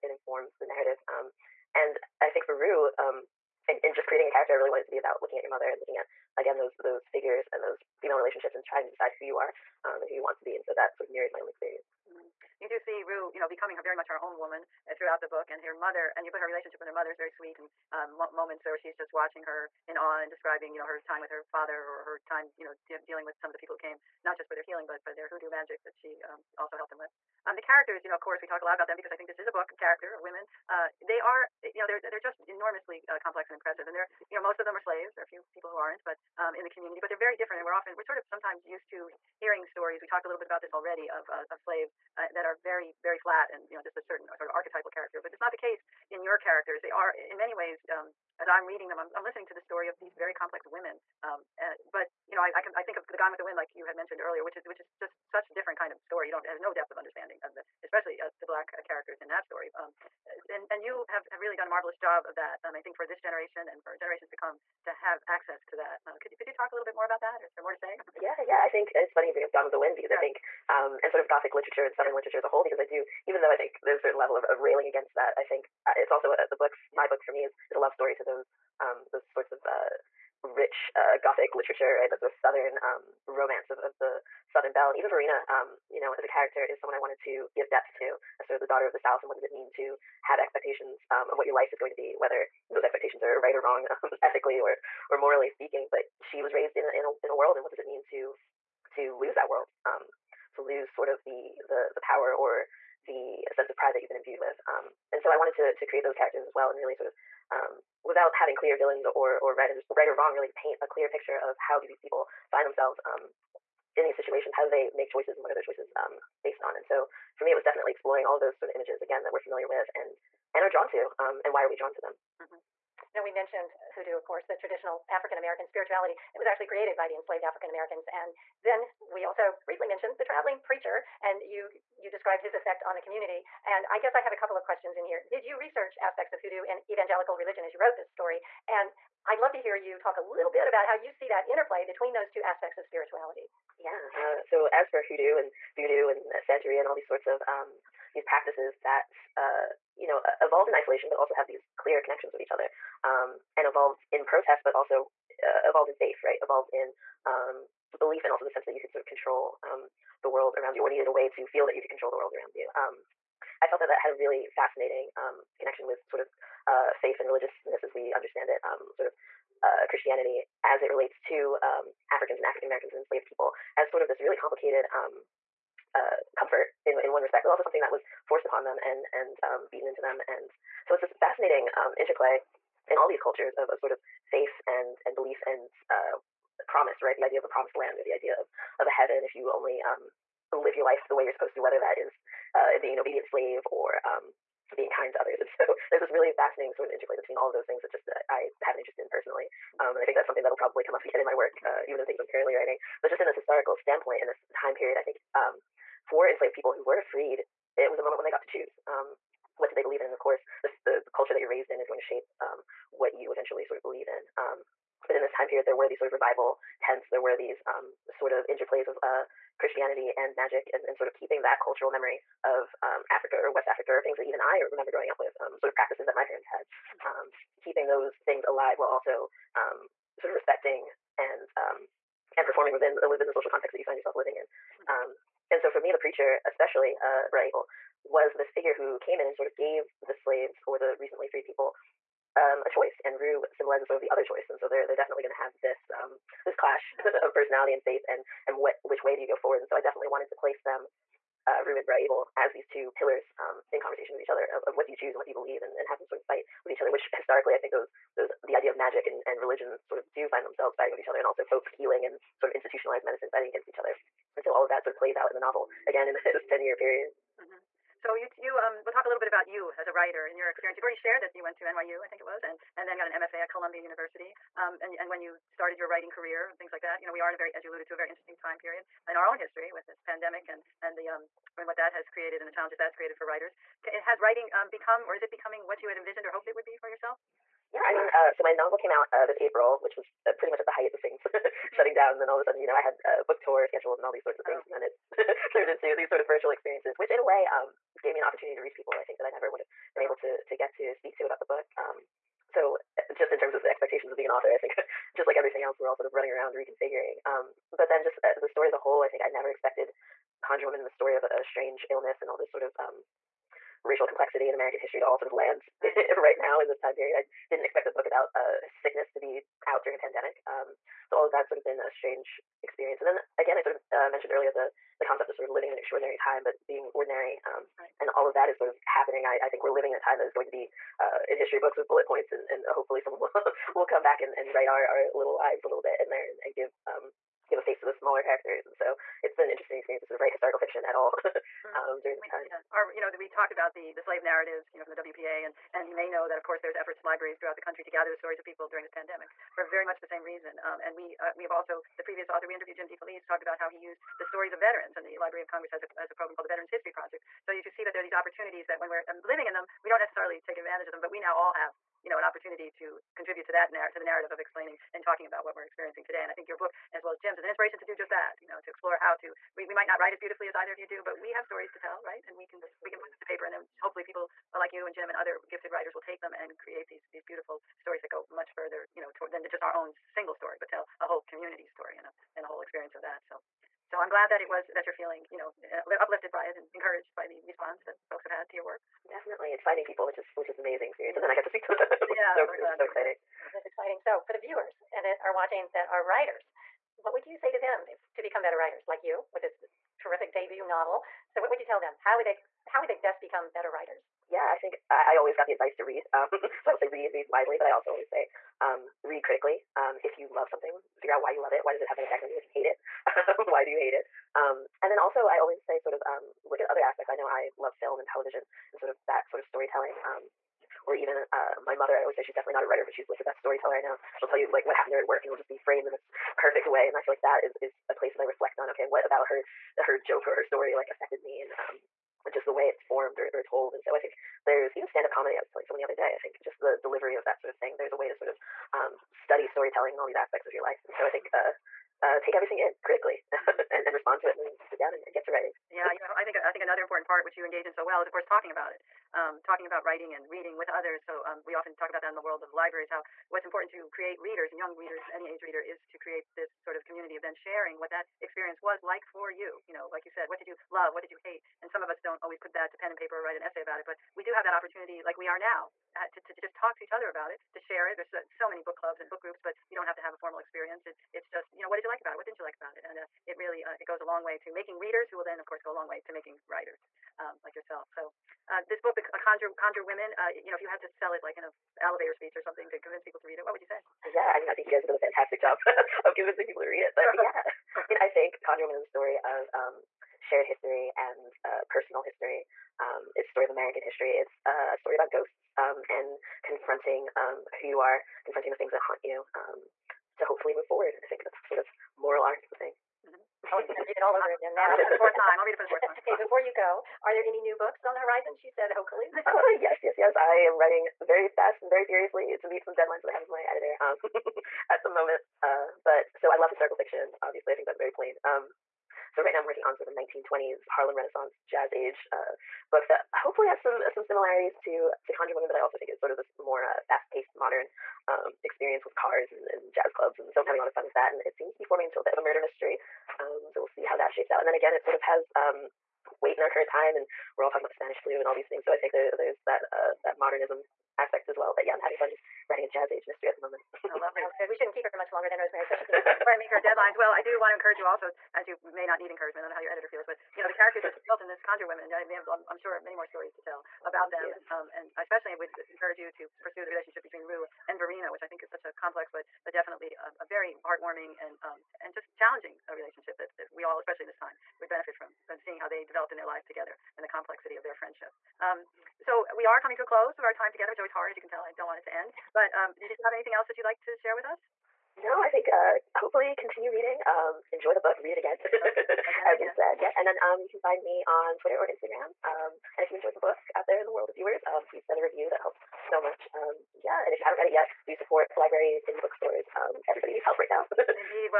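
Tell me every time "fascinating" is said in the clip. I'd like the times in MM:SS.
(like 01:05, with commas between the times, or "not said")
02:44, 03:01, 03:16.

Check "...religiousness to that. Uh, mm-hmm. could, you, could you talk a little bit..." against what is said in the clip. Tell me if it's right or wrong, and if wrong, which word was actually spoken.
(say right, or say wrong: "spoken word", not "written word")
wrong: "access", not "religiousness".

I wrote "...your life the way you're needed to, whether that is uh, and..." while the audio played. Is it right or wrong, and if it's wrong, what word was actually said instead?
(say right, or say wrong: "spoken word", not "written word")
wrong: "supposed", not "needed".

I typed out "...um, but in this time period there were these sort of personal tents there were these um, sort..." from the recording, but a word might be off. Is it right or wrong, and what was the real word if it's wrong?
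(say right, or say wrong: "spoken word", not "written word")
wrong: "revival", not "personal".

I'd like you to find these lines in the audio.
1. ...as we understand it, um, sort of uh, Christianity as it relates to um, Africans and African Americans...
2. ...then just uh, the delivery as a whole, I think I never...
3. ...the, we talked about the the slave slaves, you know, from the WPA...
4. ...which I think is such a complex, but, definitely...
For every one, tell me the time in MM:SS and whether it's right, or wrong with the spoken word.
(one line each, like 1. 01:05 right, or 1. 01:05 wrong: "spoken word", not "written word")
1. 02:47 right
2. 05:07 wrong: "story", not "delivery"
3. 05:43 wrong: "narratives", not "slaves"
4. 09:18 right.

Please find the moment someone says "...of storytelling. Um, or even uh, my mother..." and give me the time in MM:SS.
06:59.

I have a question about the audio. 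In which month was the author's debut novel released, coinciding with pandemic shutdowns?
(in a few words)
April.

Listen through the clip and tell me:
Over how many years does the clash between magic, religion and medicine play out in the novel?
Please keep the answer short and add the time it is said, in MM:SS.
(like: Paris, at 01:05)
10, at 04:26.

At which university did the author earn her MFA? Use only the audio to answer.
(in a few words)
Columbia University.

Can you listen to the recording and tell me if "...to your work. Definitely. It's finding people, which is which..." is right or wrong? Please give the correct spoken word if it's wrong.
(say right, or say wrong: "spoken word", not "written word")
right.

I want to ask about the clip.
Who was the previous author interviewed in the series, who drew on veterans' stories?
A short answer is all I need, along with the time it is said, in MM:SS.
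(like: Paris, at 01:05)
Jim DeFelice, at 05:52.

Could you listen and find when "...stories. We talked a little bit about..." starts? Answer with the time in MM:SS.
00:39.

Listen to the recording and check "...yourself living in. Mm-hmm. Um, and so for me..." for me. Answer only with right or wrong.
right.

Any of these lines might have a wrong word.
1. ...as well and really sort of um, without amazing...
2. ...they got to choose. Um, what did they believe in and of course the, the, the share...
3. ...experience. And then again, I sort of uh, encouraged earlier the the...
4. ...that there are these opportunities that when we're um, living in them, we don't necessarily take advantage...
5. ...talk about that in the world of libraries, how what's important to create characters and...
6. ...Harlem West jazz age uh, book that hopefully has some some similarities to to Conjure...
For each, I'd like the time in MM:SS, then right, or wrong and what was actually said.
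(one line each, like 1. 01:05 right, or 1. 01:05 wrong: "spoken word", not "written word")
1. 01:46 wrong: "having", not "amazing"
2. 03:28 wrong: "culture", not "share"
3. 05:22 wrong: "mentioned", not "encouraged"
4. 05:57 right
5. 07:31 wrong: "readers", not "characters"
6. 08:40 wrong: "Renaissance", not "West".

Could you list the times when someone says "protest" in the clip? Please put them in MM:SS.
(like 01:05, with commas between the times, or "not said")
02:34.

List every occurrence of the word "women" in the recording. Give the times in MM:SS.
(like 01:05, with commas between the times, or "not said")
00:30, 00:50, 07:59, 08:45, 09:11.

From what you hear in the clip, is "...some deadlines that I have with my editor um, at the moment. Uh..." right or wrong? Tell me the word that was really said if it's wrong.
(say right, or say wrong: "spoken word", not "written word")
right.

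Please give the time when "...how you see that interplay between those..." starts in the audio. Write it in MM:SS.
02:20.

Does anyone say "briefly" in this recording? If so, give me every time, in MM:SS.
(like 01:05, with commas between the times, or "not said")
02:09.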